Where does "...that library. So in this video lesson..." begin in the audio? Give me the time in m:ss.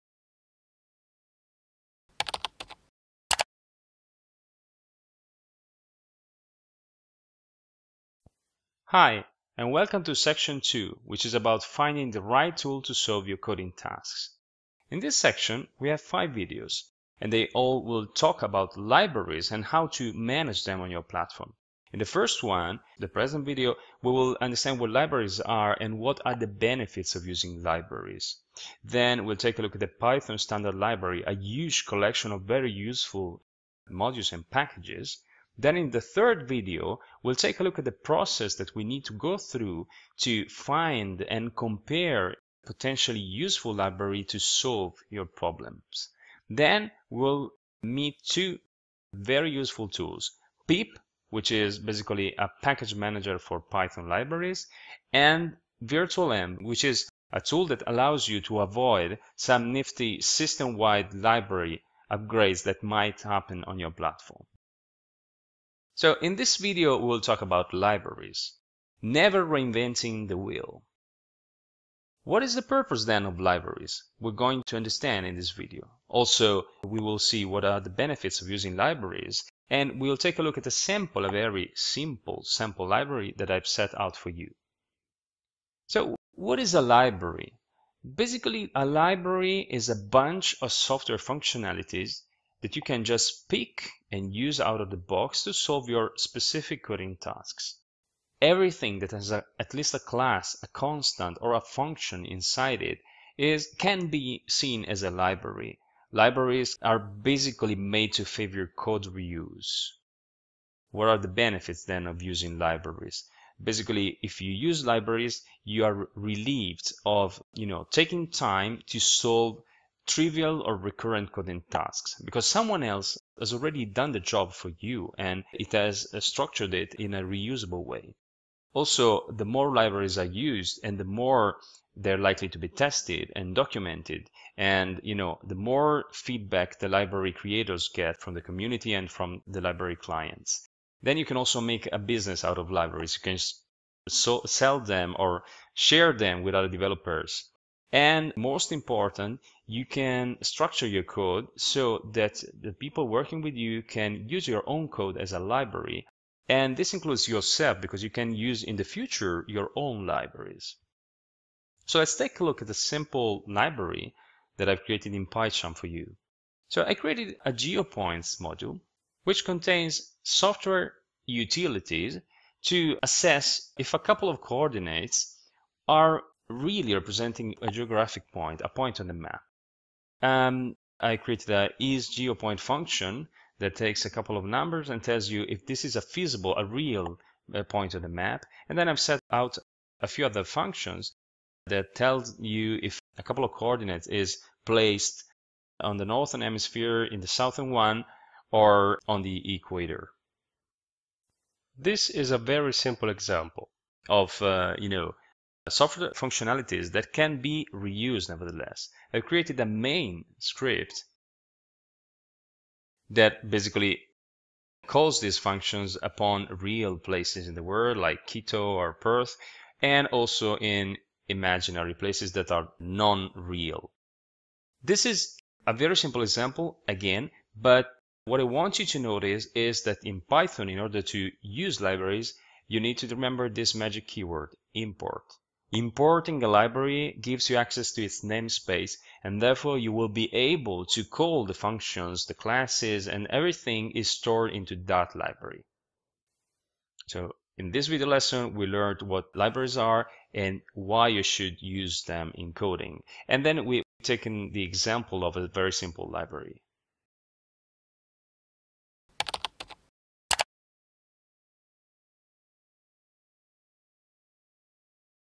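4:04.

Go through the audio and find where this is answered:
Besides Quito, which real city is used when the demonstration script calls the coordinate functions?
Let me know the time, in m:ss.
3:38.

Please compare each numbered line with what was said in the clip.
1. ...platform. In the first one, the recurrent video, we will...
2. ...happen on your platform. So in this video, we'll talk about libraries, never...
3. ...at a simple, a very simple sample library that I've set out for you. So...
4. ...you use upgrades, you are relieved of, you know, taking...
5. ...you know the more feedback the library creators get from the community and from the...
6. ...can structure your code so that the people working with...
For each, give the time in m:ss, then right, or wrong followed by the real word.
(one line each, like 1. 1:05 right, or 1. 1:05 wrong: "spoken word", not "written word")
1. 0:21 wrong: "present", not "recurrent"
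2. 1:03 right
3. 1:20 wrong: "sample", not "simple"
4. 1:54 wrong: "libraries", not "upgrades"
5. 2:15 right
6. 2:29 right.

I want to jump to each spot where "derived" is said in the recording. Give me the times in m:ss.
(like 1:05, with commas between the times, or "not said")
not said.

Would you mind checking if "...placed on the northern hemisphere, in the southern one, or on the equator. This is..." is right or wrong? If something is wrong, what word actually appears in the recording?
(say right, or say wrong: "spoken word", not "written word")
right.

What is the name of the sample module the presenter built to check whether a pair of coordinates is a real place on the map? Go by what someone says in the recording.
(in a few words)
GeoPoints.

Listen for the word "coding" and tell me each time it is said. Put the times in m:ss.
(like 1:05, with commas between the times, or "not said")
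0:13, 1:36, 2:01, 4:12.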